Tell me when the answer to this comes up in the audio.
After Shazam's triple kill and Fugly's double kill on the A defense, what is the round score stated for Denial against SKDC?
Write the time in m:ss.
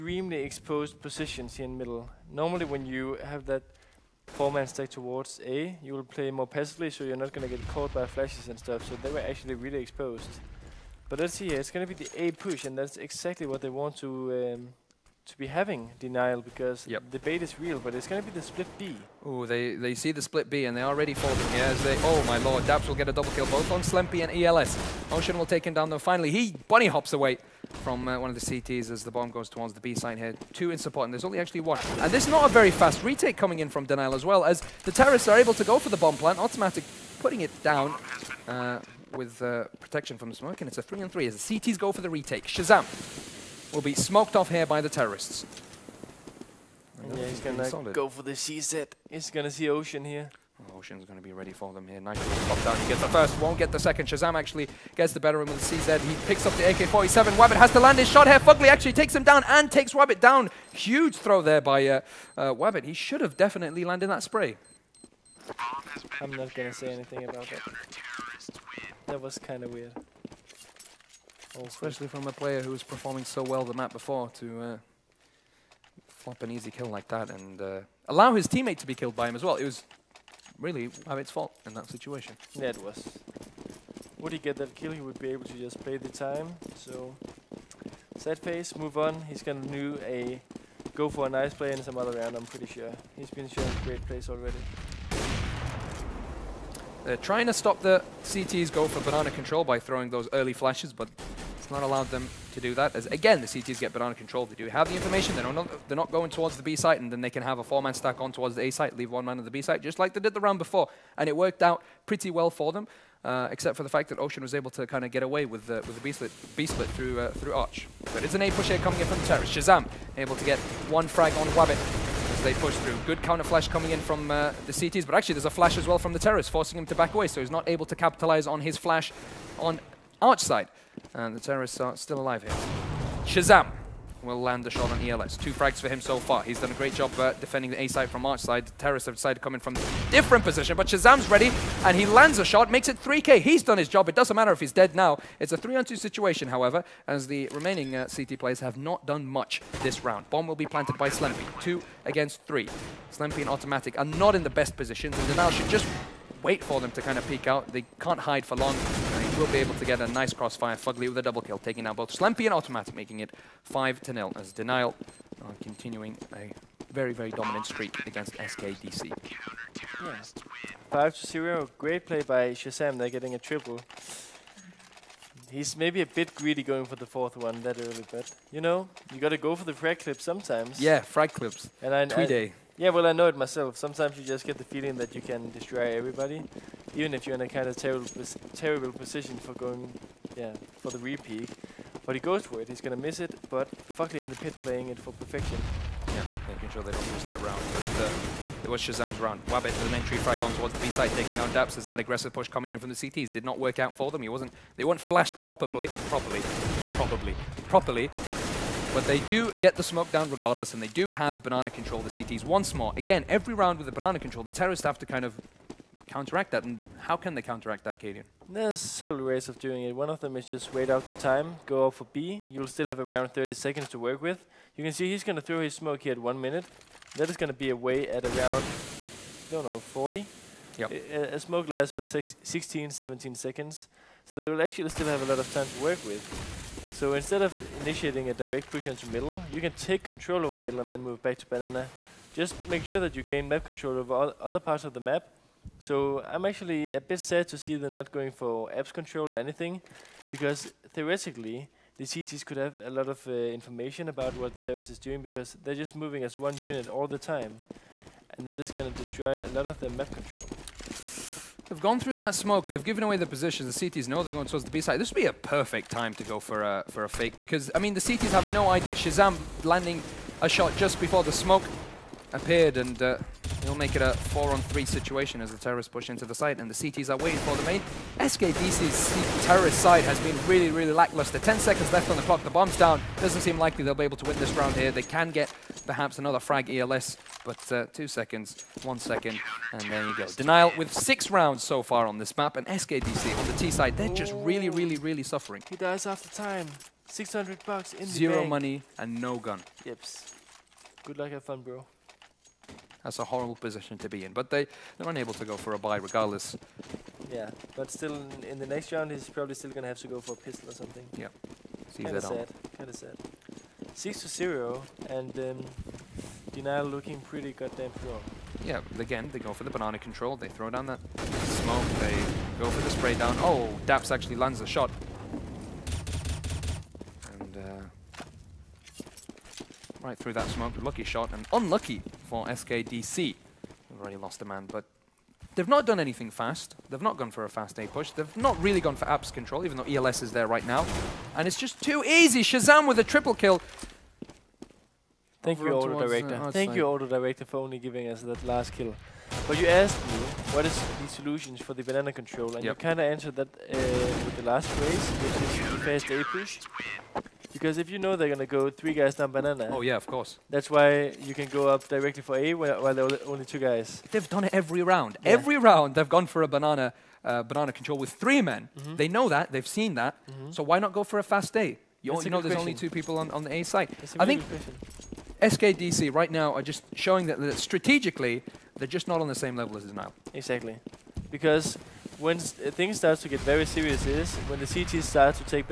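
2:43.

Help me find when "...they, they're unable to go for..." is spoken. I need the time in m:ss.
5:04.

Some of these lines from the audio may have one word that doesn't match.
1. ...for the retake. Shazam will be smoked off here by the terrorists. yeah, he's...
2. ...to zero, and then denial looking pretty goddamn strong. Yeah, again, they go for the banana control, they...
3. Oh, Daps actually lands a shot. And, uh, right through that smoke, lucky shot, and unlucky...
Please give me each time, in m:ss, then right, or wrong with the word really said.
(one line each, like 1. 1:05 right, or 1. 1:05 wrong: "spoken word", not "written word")
1. 0:41 right
2. 5:14 right
3. 5:23 right.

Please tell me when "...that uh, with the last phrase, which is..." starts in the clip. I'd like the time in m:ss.
5:53.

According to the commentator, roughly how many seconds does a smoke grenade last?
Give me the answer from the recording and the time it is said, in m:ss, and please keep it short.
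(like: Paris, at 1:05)
16 to 17 seconds, at 3:52.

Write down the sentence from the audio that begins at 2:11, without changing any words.
And the terrorists are still alive here.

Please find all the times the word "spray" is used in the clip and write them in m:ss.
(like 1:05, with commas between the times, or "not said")
1:04, 5:22.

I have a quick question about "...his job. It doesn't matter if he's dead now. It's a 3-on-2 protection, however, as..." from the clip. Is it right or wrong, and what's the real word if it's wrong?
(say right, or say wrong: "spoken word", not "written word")
wrong: "situation", not "protection".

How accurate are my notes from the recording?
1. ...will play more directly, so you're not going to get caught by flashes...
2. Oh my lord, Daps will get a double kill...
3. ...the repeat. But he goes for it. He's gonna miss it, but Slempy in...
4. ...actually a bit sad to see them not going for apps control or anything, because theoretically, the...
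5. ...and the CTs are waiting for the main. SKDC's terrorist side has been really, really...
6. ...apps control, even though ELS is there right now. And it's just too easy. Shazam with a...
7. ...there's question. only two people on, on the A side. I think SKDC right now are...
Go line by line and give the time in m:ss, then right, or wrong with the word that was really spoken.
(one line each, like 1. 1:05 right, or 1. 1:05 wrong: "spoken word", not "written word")
1. 0:05 wrong: "passively", not "directly"
2. 0:22 right
3. 3:10 wrong: "Fugly", not "Slempy"
4. 4:06 right
5. 4:36 right
6. 5:39 right
7. 6:12 right.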